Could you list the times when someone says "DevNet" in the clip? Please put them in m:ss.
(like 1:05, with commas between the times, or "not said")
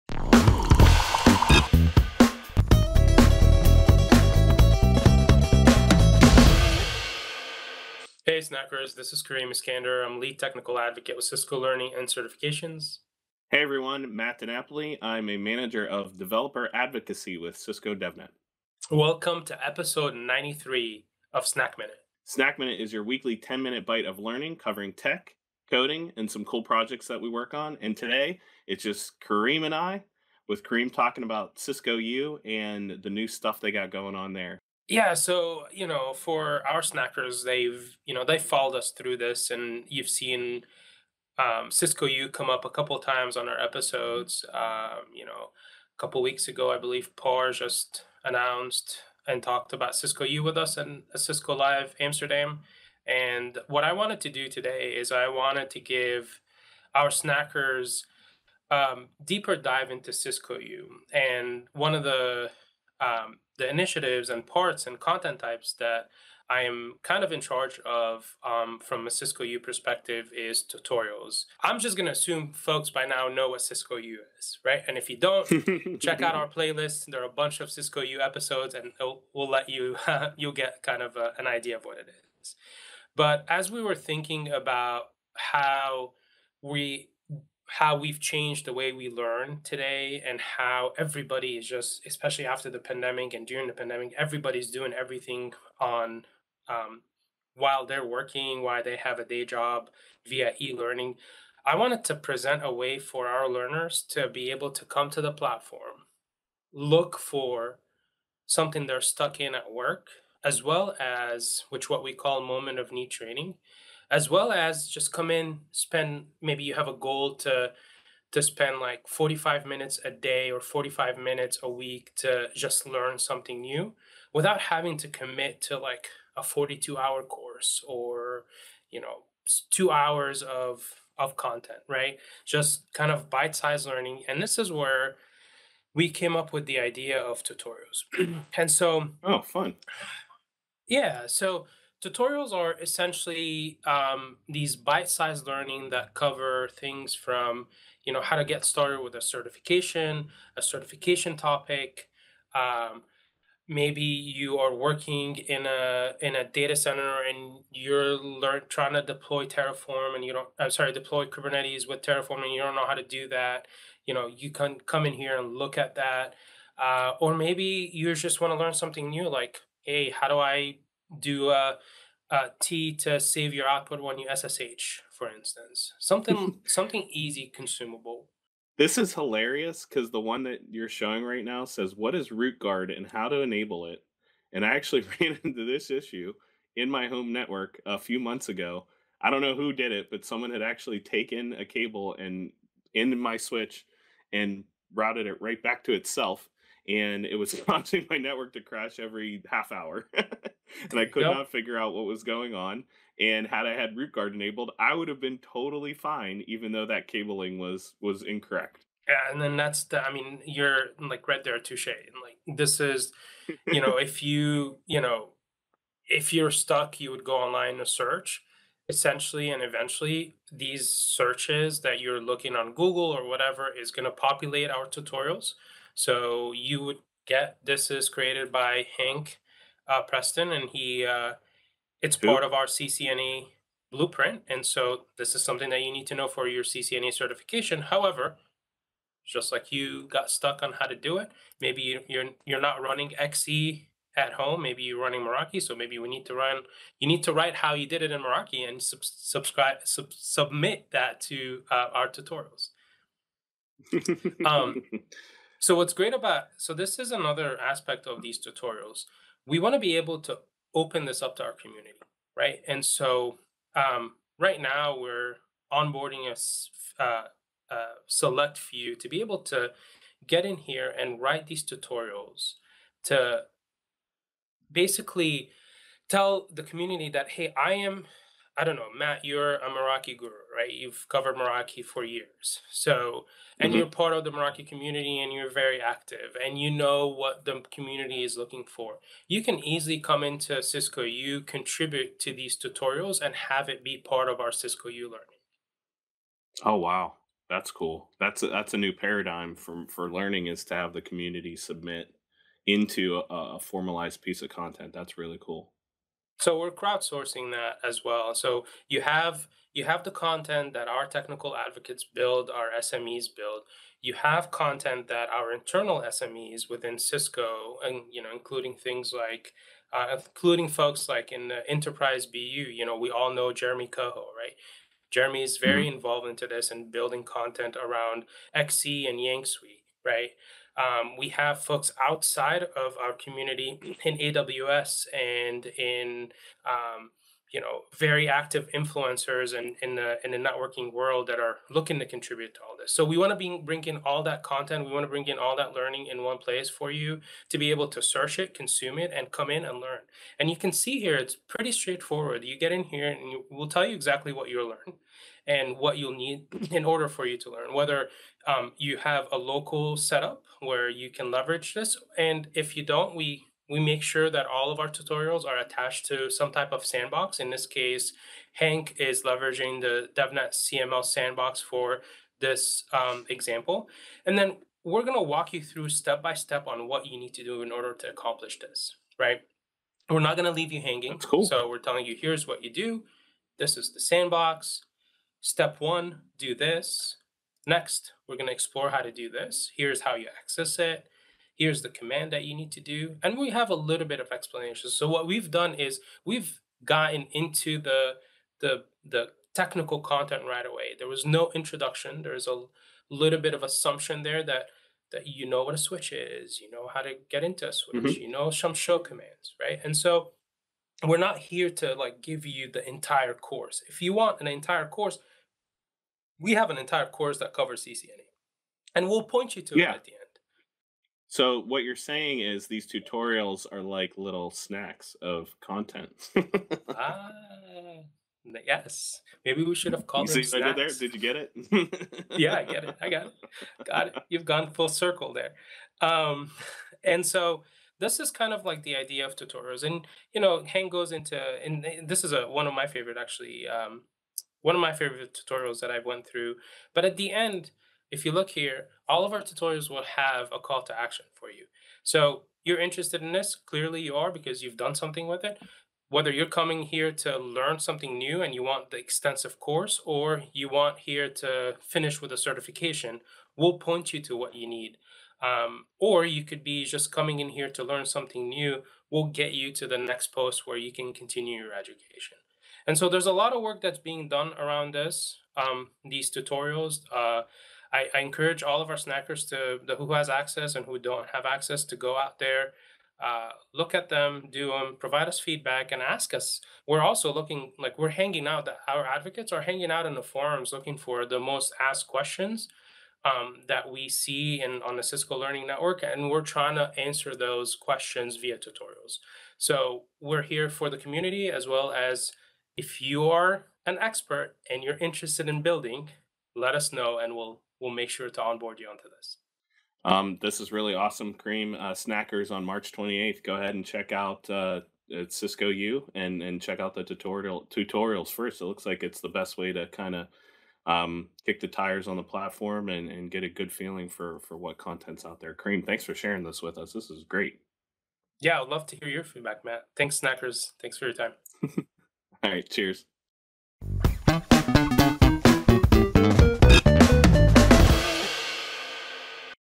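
0:17, 6:10.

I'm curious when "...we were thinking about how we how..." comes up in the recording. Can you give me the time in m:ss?
1:23.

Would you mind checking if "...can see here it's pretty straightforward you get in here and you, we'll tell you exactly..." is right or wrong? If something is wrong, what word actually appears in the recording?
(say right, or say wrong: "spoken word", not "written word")
right.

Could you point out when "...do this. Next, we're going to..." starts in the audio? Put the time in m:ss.
6:26.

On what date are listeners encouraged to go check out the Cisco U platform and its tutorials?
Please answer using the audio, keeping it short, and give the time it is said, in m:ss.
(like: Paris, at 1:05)
March 28th, at 8:32.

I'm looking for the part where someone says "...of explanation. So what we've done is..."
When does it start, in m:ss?
6:34.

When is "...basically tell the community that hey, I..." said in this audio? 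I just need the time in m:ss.
4:34.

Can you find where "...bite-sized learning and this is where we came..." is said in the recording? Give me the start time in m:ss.
2:13.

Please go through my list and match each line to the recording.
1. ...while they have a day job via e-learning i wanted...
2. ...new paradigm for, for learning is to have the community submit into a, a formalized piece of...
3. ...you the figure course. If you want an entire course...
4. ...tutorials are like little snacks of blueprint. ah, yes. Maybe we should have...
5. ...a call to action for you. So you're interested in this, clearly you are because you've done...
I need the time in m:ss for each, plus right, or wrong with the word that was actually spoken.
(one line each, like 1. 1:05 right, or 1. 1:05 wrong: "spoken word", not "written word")
1. 1:38 right
2. 4:58 right
3. 6:52 wrong: "entire", not "figure"
4. 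7:02 wrong: "content", not "blueprint"
5. 7:30 right.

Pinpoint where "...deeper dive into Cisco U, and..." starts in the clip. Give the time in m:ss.
0:59.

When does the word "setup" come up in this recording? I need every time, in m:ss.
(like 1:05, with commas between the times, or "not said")
5:59.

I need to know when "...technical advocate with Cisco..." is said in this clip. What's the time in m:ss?
0:10.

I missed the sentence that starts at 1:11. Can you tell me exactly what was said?
I'm just going to assume folks by now know what Cisco U is, right?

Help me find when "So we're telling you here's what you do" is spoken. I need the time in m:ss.
6:21.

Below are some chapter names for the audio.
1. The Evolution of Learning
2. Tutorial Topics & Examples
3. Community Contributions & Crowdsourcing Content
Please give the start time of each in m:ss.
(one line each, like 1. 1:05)
1. 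1:23
2. 2:14
3. 4:18.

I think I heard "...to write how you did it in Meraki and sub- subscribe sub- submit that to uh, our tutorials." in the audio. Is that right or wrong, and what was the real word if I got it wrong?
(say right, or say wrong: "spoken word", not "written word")
right.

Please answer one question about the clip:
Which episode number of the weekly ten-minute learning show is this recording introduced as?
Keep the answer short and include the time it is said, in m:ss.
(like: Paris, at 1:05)
93, at 0:19.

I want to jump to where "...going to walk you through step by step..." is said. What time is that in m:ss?
6:15.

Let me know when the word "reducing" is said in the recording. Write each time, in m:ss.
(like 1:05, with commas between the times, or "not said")
not said.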